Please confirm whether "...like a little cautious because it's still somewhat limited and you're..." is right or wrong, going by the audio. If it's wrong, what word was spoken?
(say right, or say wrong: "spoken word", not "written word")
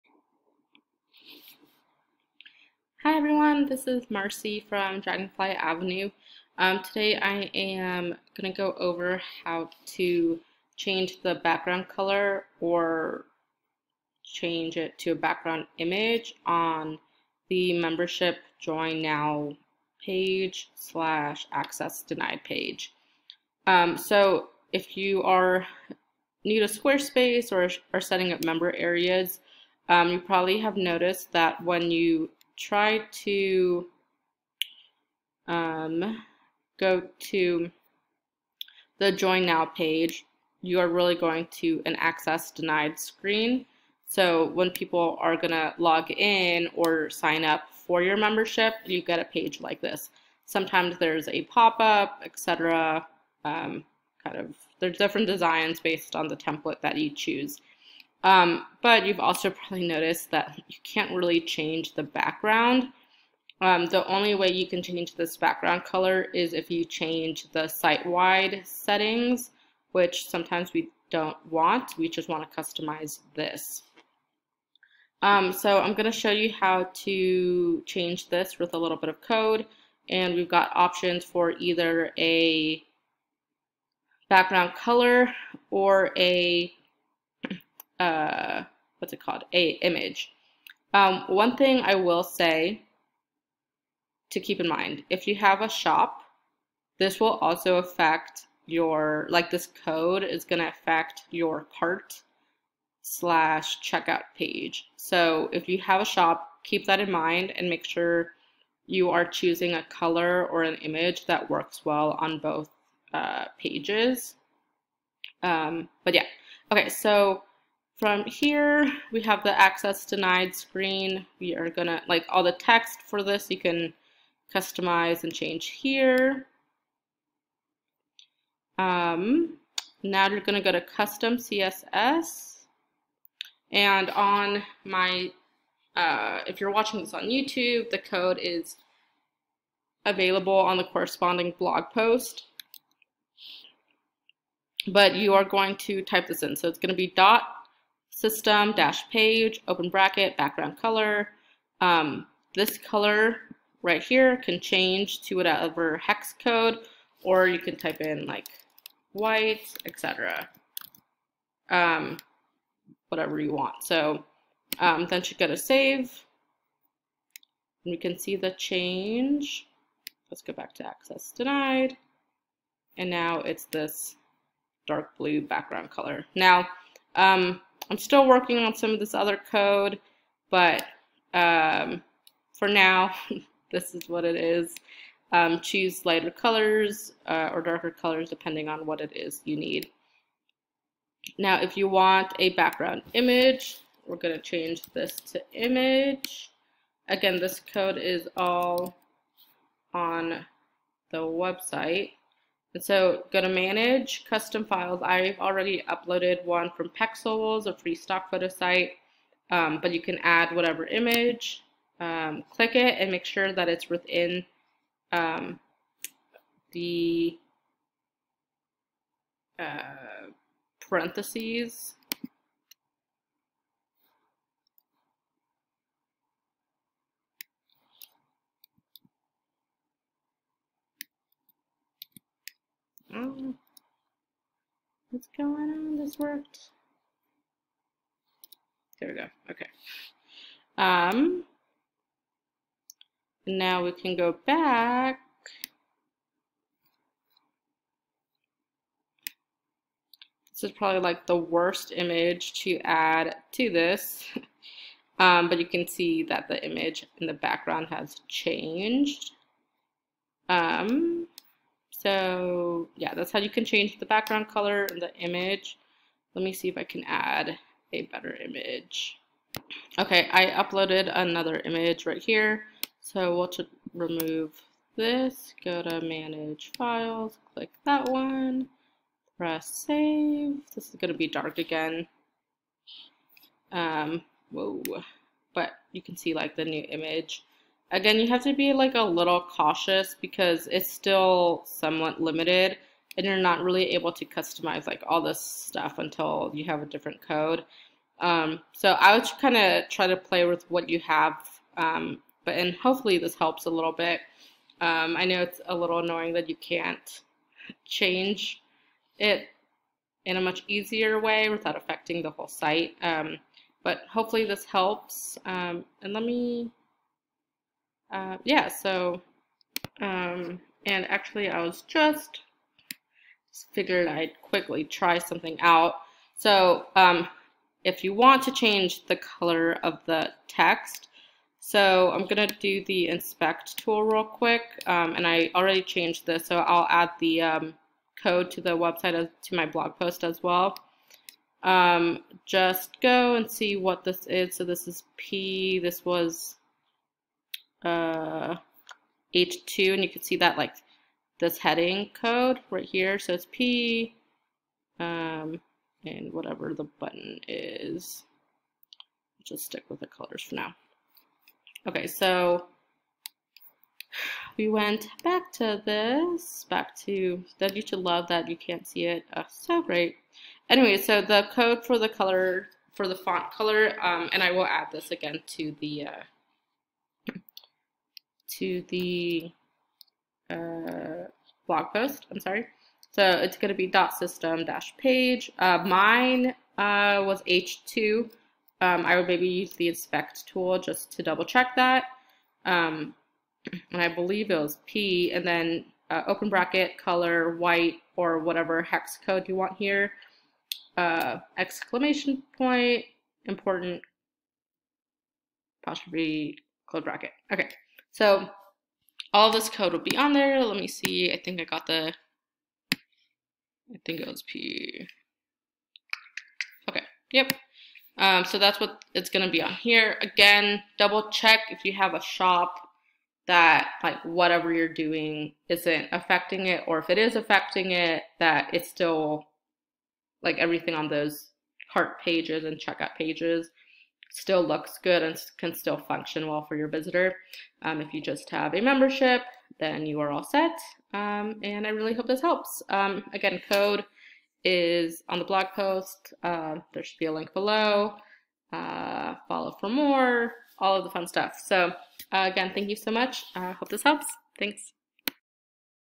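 right.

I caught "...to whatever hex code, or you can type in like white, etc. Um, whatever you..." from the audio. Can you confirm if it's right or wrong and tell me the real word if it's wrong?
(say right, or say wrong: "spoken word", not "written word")
right.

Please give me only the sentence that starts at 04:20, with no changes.
Um, so yeah, that's how you can change the background color and the image.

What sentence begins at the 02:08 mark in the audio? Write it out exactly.
Um, now you're gonna go to custom CSS.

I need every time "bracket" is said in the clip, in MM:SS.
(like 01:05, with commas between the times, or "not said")
02:29, 06:36, 06:47.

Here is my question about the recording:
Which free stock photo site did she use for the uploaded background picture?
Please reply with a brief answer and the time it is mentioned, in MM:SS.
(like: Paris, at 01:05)
Pexels, at 03:26.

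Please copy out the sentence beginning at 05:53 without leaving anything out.
So it's P, um, and whatever the button is.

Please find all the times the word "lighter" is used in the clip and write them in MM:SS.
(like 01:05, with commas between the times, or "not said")
03:06.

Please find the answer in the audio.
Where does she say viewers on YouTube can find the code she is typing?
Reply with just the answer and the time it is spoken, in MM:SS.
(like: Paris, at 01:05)
the corresponding blog post, at 02:20.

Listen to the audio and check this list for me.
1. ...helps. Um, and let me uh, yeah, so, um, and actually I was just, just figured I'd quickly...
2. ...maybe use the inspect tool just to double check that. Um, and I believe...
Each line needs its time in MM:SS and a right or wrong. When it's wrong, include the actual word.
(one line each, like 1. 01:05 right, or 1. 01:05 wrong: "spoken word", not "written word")
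1. 05:14 right
2. 06:29 right.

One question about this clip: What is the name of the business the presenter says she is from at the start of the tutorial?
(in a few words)
Dragonfly Avenue.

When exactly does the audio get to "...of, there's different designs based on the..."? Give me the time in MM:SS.
00:54.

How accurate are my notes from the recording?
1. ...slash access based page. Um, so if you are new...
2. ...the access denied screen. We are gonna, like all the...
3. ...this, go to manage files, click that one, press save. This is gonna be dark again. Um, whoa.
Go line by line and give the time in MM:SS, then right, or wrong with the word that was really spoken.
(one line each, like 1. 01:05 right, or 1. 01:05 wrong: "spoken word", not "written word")
1. 00:20 wrong: "denied", not "based"
2. 01:59 right
3. 04:34 right.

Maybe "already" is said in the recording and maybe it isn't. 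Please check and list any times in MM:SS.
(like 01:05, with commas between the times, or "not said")
03:25, 05:35.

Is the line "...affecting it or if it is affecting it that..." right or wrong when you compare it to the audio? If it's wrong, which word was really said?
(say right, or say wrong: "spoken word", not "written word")
right.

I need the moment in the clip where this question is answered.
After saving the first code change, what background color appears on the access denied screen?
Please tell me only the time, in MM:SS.
02:54.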